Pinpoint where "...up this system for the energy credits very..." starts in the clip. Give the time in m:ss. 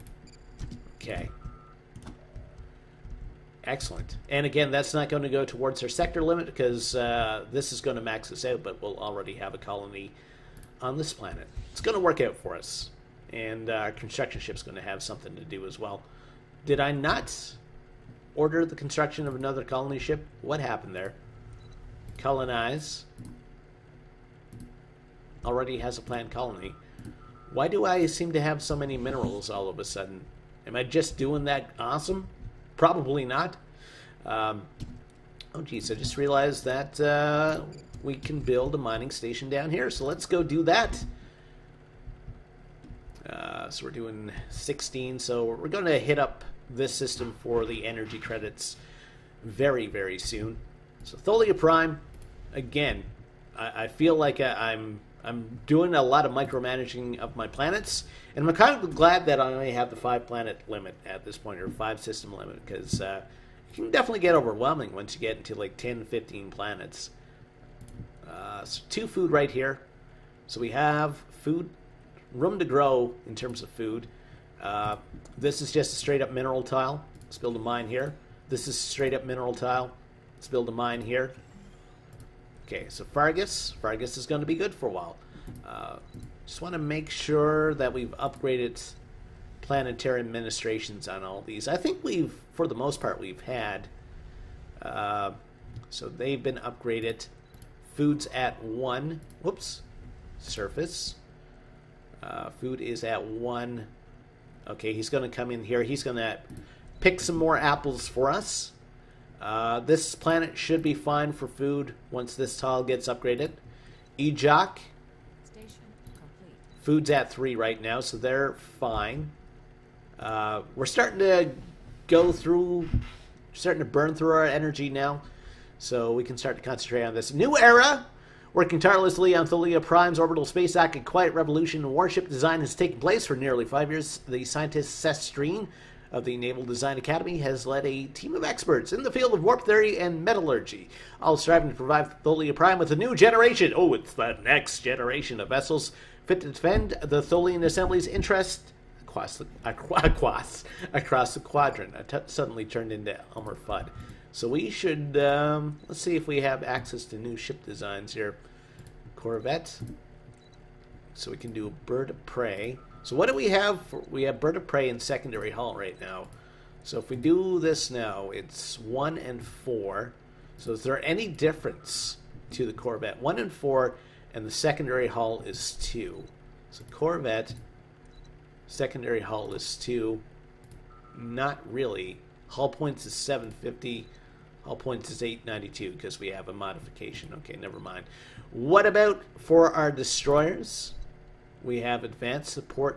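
0:46.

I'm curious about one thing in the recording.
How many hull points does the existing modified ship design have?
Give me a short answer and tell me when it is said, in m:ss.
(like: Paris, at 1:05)
892, at 3:05.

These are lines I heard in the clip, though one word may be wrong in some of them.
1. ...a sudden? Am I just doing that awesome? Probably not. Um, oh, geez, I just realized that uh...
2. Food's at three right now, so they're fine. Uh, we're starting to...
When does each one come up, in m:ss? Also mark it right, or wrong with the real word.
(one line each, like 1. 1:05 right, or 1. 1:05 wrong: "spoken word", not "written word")
1. 0:29 right
2. 1:56 right.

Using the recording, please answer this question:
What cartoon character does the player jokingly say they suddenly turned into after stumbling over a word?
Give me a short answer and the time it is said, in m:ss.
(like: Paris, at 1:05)
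Elmer Fudd, at 2:33.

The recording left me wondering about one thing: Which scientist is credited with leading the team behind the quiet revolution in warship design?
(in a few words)
Seth Streen.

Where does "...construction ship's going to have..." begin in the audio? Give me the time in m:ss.
0:13.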